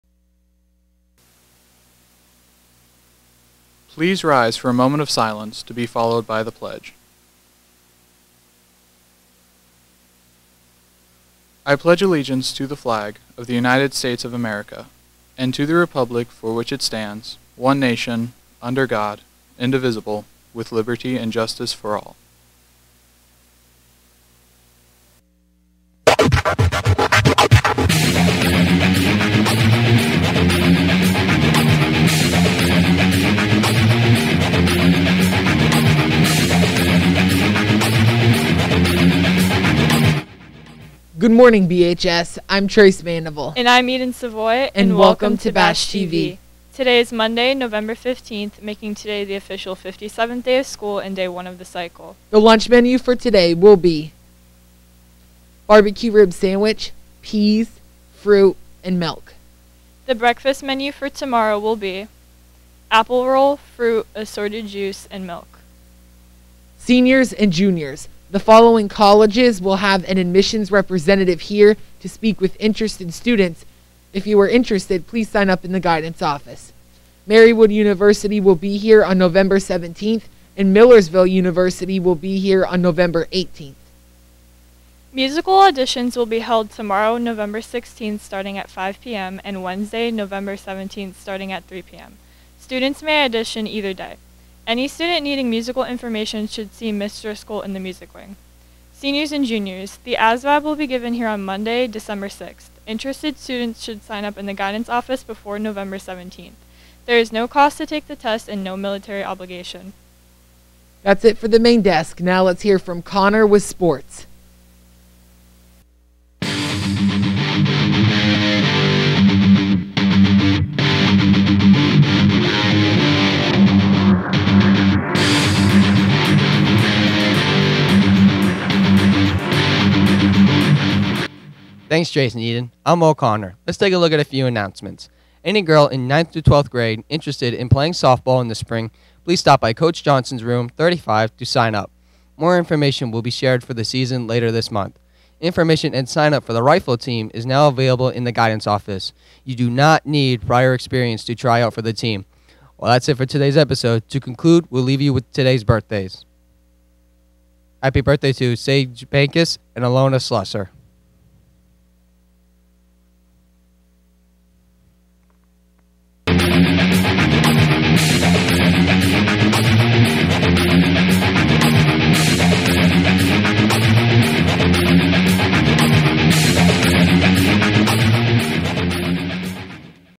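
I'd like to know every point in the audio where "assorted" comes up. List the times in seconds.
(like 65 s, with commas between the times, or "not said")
64 s.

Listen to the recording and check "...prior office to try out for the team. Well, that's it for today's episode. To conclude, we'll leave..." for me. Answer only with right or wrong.
wrong.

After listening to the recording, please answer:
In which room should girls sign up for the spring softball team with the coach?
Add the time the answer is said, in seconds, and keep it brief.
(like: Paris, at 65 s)
Room 35, at 140 s.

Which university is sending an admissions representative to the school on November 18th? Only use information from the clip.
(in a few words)
Millersville University.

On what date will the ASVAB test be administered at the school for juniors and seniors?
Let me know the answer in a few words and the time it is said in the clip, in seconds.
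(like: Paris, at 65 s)
December 6th, at 101 s.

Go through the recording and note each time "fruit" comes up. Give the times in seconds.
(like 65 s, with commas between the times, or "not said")
58 s, 63 s.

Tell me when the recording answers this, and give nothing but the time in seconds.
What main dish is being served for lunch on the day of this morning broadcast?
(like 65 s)
55 s.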